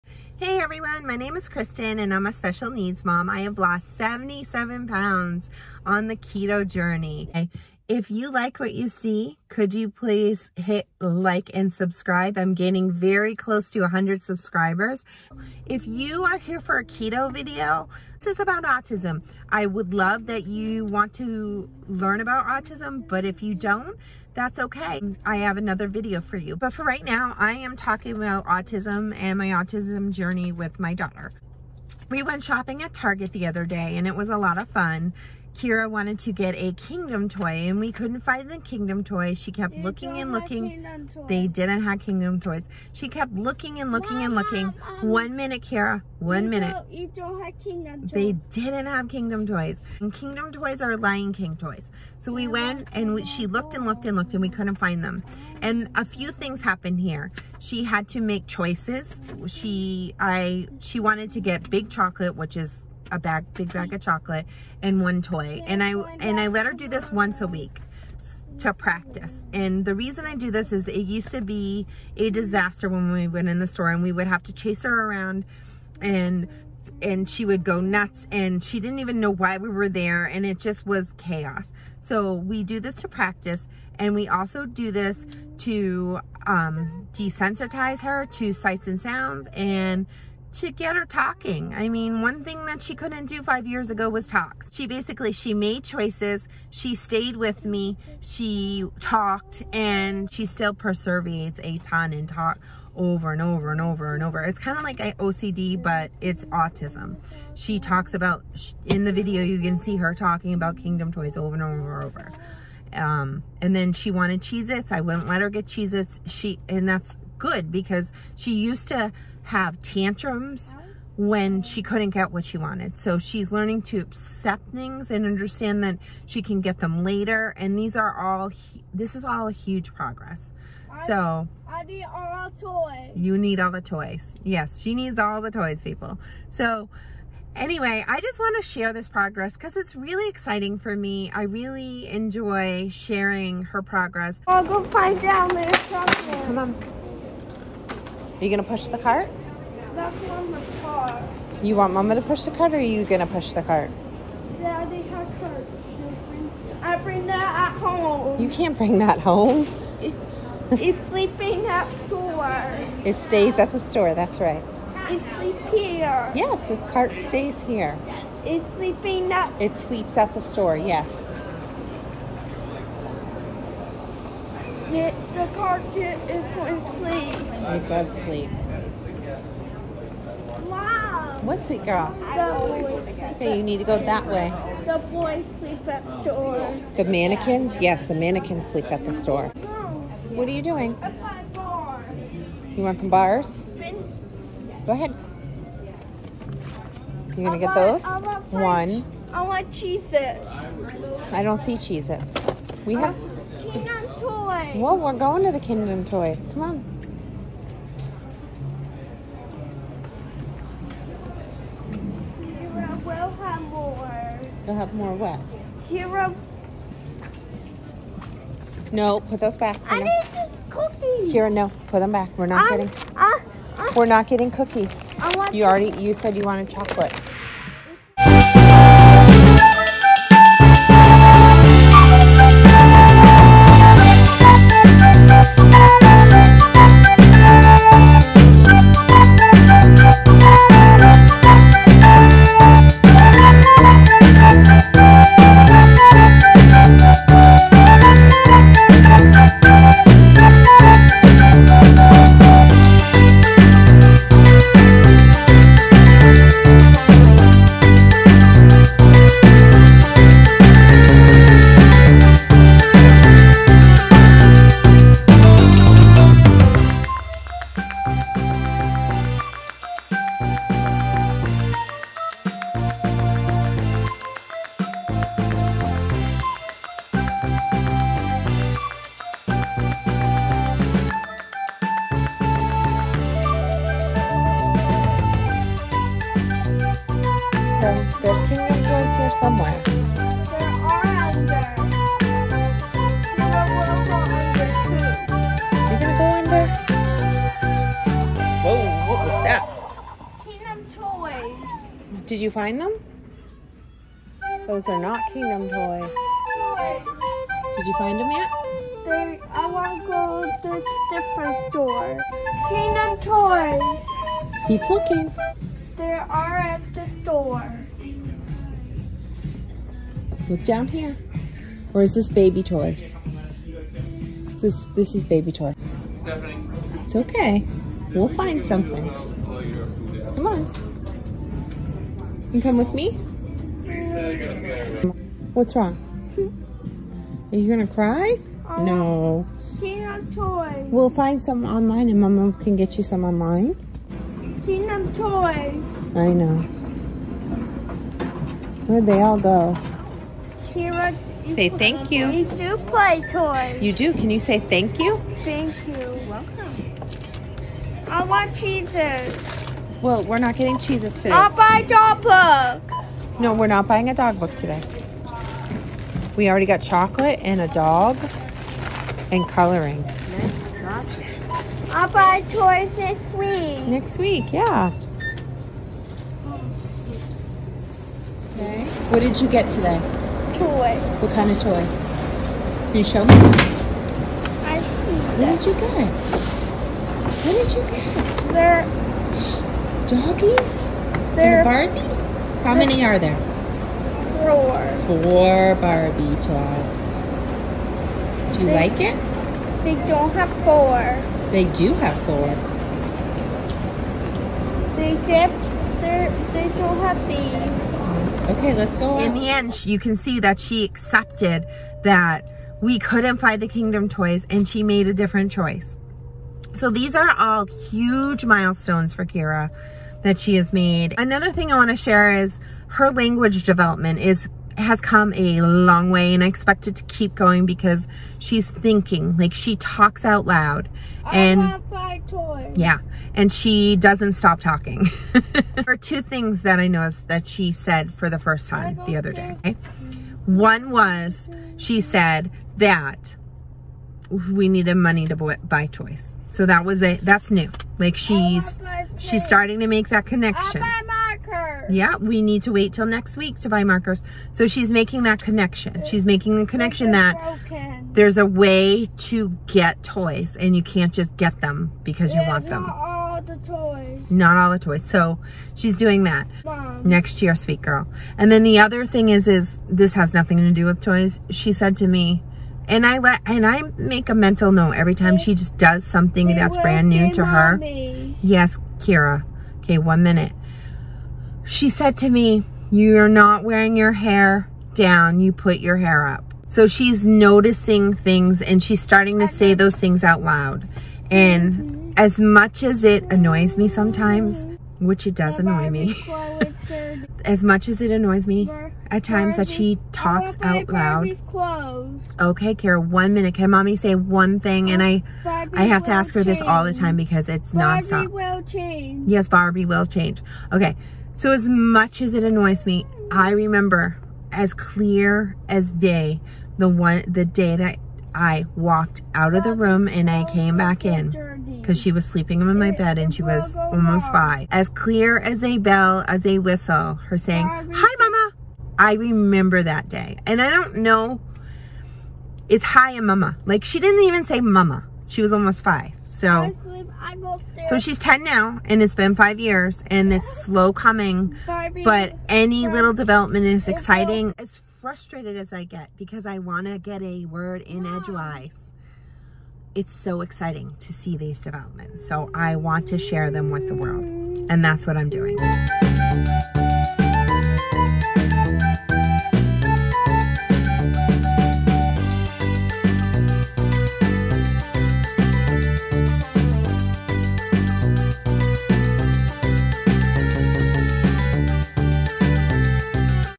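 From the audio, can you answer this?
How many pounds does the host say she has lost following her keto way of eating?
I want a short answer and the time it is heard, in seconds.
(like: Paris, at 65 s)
77, at 3 s.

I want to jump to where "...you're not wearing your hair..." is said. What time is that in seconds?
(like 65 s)
482 s.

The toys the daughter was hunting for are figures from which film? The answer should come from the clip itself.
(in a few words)
Lion King.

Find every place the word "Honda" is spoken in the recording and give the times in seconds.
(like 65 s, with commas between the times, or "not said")
not said.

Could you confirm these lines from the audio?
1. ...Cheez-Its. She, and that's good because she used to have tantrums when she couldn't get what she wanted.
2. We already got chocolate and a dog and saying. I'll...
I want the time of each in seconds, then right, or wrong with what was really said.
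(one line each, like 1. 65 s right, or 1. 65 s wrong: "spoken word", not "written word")
1. 115 s right
2. 366 s wrong: "coloring", not "saying".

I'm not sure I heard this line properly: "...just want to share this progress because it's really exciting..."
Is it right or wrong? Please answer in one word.
right.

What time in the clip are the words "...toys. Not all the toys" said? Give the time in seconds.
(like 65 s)
463 s.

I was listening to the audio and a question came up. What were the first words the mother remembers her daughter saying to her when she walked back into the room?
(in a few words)
Hi mama.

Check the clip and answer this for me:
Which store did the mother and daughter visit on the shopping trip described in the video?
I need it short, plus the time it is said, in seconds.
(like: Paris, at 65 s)
Target, at 32 s.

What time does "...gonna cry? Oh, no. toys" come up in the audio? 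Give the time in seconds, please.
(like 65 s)
337 s.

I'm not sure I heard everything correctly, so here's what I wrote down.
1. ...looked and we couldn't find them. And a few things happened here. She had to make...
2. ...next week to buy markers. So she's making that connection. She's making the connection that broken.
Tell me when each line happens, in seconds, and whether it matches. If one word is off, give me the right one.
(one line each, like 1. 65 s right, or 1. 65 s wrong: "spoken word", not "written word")
1. 54 s right
2. 453 s right.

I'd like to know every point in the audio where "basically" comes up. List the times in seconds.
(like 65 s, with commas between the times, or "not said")
94 s.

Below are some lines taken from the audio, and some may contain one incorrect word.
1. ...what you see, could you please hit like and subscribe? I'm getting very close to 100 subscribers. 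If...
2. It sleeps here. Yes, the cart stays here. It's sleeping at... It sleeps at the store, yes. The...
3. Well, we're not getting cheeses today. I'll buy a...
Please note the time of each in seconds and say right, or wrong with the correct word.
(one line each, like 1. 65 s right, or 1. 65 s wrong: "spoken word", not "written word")
1. 8 s right
2. 165 s right
3. 360 s right.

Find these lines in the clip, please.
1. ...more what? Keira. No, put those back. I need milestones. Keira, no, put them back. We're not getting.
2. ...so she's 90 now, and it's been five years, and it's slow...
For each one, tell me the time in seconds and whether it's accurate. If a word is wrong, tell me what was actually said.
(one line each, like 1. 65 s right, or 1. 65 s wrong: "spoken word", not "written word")
1. 214 s wrong: "cookies", not "milestones"
2. 537 s wrong: "10", not "90".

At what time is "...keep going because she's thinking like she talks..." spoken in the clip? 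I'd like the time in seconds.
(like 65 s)
427 s.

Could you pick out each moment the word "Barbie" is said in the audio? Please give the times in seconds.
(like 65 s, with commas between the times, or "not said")
391 s, 395 s, 509 s.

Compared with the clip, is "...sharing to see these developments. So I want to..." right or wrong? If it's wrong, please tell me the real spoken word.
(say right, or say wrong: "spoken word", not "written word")
wrong: "exciting", not "sharing".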